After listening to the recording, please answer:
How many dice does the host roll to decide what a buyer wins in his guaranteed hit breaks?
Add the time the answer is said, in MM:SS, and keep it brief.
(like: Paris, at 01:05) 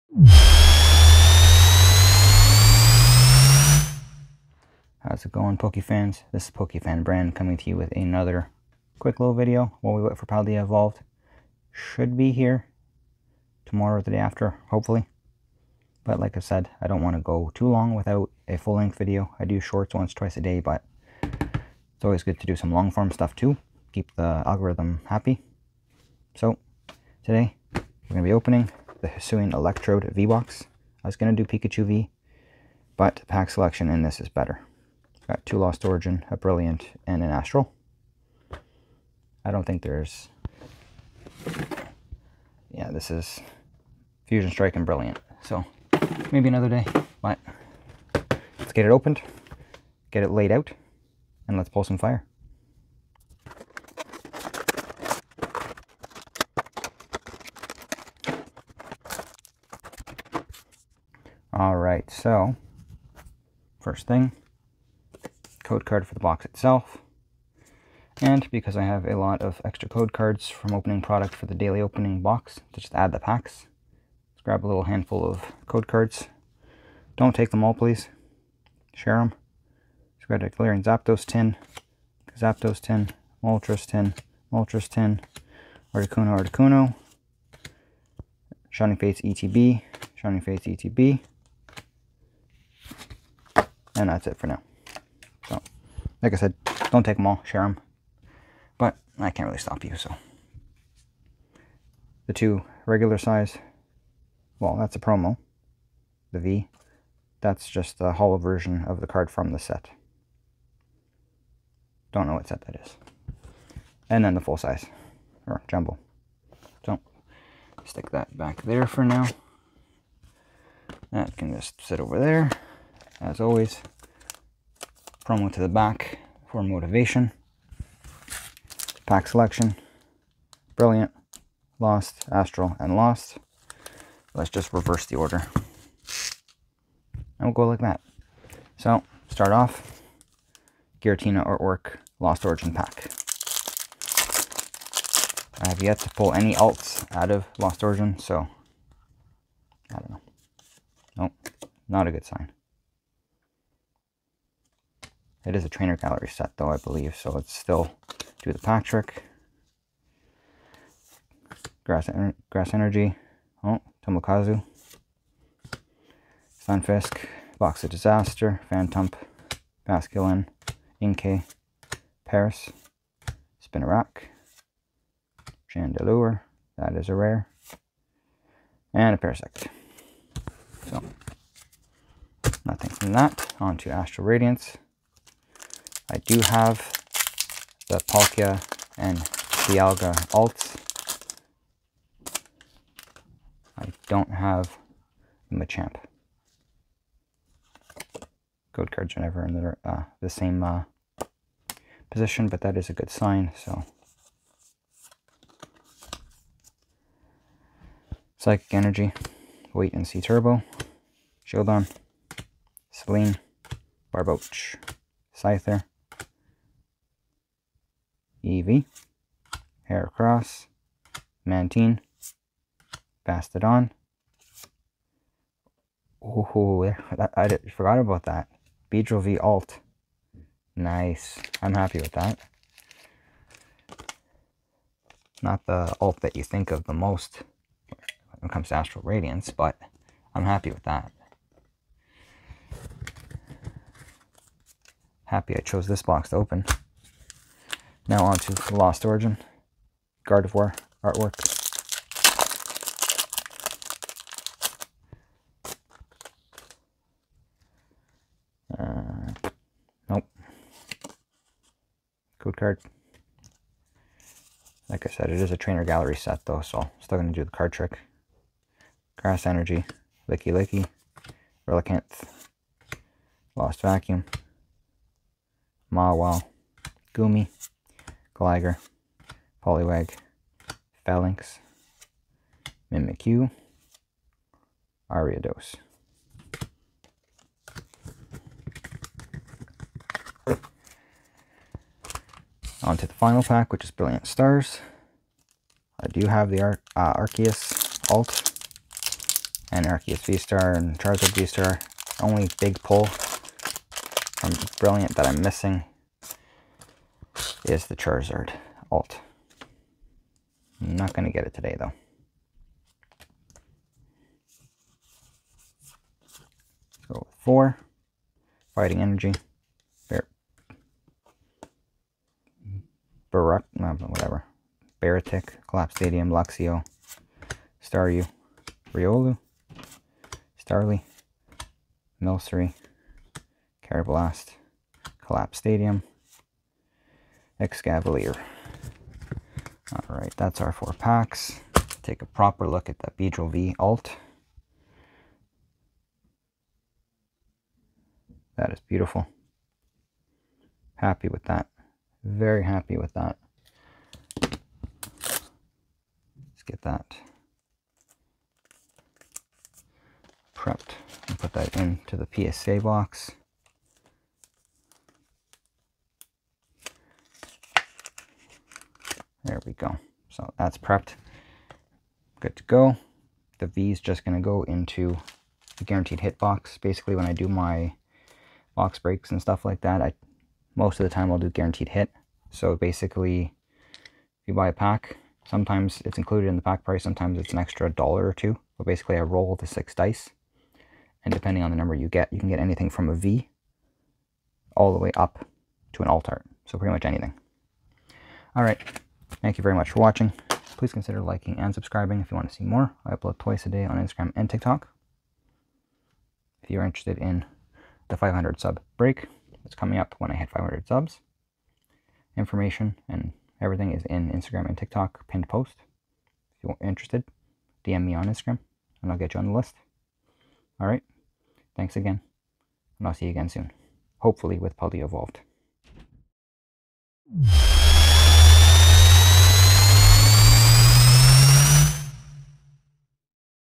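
6, at 06:29.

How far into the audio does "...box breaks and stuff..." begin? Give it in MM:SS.
06:18.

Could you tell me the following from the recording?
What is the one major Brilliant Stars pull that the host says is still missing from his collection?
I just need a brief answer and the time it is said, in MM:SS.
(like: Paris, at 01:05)
Charizard alt, at 05:07.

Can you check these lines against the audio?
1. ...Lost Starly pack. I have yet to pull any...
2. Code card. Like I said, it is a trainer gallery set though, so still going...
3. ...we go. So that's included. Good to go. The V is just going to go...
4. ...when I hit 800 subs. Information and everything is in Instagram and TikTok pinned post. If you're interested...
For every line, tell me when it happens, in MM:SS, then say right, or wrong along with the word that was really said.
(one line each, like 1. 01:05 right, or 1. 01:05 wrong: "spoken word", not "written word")
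1. 02:22 wrong: "Origin", not "Starly"
2. 04:22 right
3. 06:09 wrong: "prepped", not "included"
4. 06:50 wrong: "500", not "800".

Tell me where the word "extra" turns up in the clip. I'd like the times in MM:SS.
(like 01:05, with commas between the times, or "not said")
01:09, 06:27.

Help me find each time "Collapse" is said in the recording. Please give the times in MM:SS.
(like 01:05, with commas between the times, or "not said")
05:25, 05:35.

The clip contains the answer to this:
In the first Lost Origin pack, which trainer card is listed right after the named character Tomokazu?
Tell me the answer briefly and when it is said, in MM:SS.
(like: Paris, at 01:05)
Box of Disaster, at 02:47.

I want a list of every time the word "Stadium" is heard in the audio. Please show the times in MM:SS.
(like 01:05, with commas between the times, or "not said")
05:25, 05:35.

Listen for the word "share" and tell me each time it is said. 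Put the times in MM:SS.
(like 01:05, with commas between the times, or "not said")
01:18, 01:37.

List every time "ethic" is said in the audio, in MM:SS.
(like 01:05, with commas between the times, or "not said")
not said.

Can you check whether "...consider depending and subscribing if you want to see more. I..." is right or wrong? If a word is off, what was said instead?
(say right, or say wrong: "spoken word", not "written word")
wrong: "liking", not "depending".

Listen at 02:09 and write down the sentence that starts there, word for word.
Pack selection, brilliant, lost, astral, and lost.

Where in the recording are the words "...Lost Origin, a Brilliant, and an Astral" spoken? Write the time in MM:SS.
00:35.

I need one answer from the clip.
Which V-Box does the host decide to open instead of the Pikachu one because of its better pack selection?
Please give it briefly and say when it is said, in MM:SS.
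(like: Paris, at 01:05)
Hisuian Electrode V-Box, at 00:29.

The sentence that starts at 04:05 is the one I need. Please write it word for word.
Happy I chose this box to open.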